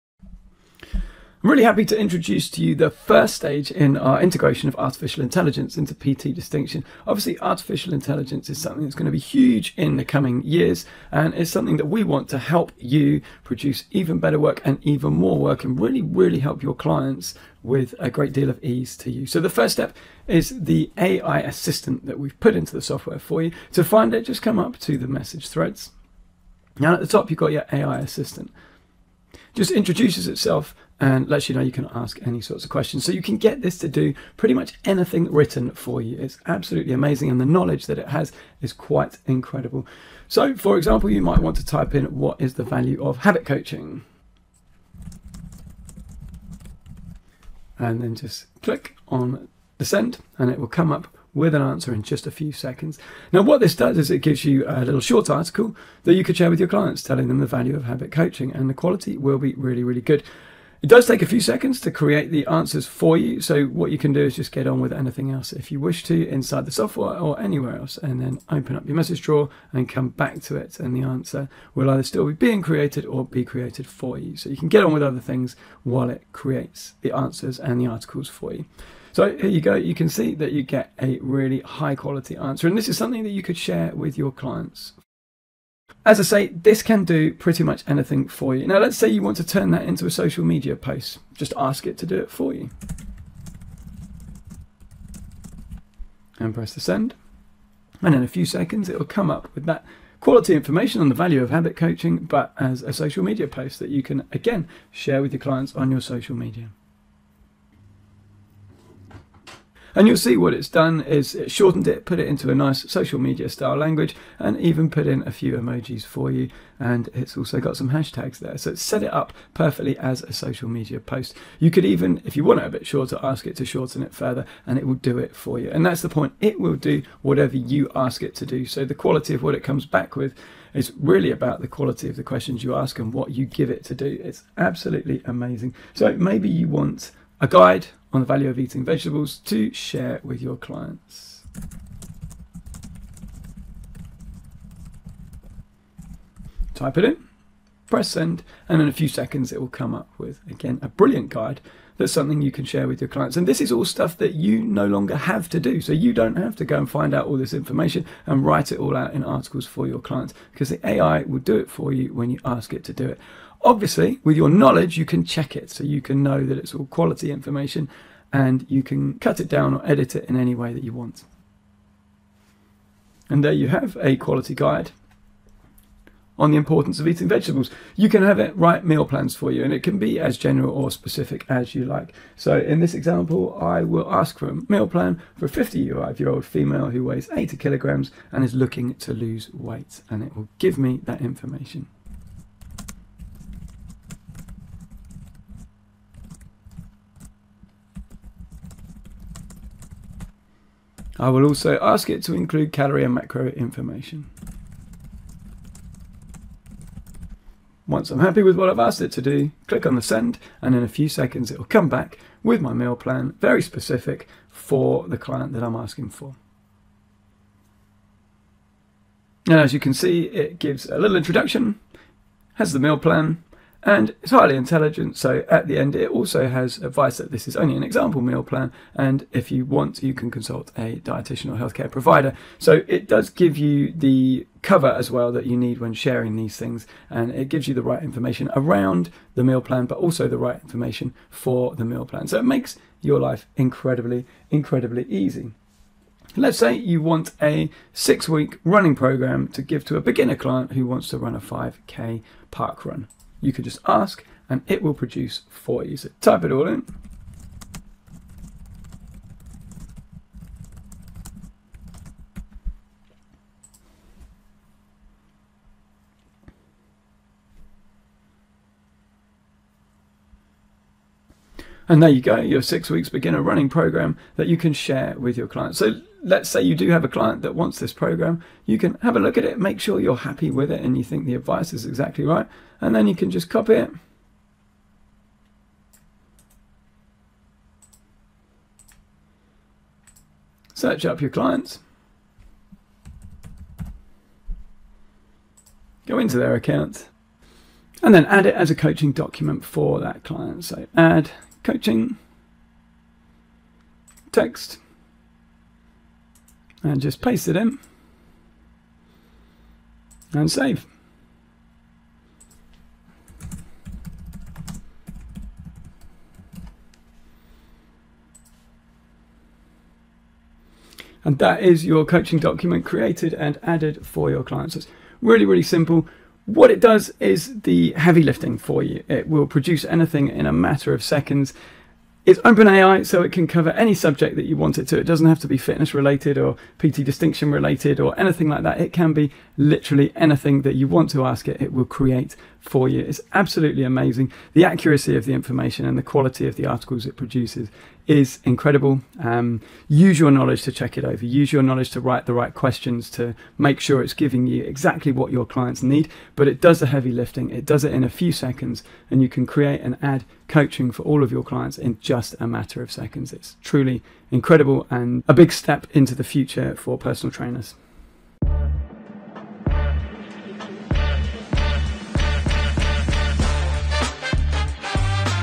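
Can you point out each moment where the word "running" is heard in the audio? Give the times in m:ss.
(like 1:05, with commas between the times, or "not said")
4:08, 4:33.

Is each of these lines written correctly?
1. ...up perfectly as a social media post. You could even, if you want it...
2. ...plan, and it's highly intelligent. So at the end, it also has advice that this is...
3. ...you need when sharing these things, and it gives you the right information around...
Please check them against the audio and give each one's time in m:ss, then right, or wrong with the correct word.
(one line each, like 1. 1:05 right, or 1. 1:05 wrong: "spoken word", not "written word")
1. 1:59 right
2. 3:42 right
3. 3:55 right.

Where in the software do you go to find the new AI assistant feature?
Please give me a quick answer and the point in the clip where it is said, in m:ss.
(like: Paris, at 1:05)
Message threads, at 0:25.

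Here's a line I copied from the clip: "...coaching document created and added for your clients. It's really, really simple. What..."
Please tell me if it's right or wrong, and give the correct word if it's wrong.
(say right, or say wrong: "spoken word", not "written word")
right.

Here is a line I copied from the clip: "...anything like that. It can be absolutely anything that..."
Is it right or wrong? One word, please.
wrong.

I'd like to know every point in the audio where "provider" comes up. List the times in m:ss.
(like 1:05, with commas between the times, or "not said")
3:51.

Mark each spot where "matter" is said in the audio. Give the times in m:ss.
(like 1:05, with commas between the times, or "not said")
5:30, 6:02.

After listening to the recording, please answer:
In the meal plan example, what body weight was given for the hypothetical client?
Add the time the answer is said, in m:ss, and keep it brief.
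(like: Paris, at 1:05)
80 kilograms, at 3:07.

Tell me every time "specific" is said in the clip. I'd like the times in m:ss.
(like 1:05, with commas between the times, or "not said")
3:00, 3:33.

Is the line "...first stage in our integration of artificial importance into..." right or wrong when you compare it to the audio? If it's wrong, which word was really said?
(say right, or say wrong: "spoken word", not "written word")
wrong: "intelligence", not "importance".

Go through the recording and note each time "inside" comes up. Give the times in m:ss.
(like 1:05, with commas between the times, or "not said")
1:06.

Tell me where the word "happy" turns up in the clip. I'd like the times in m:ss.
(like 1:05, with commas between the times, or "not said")
0:01, 3:28, 4:40.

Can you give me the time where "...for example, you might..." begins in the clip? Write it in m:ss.
0:40.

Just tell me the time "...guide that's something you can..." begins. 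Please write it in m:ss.
2:31.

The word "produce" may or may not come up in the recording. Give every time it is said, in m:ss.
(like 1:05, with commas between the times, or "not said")
0:13, 4:14, 5:29, 5:47.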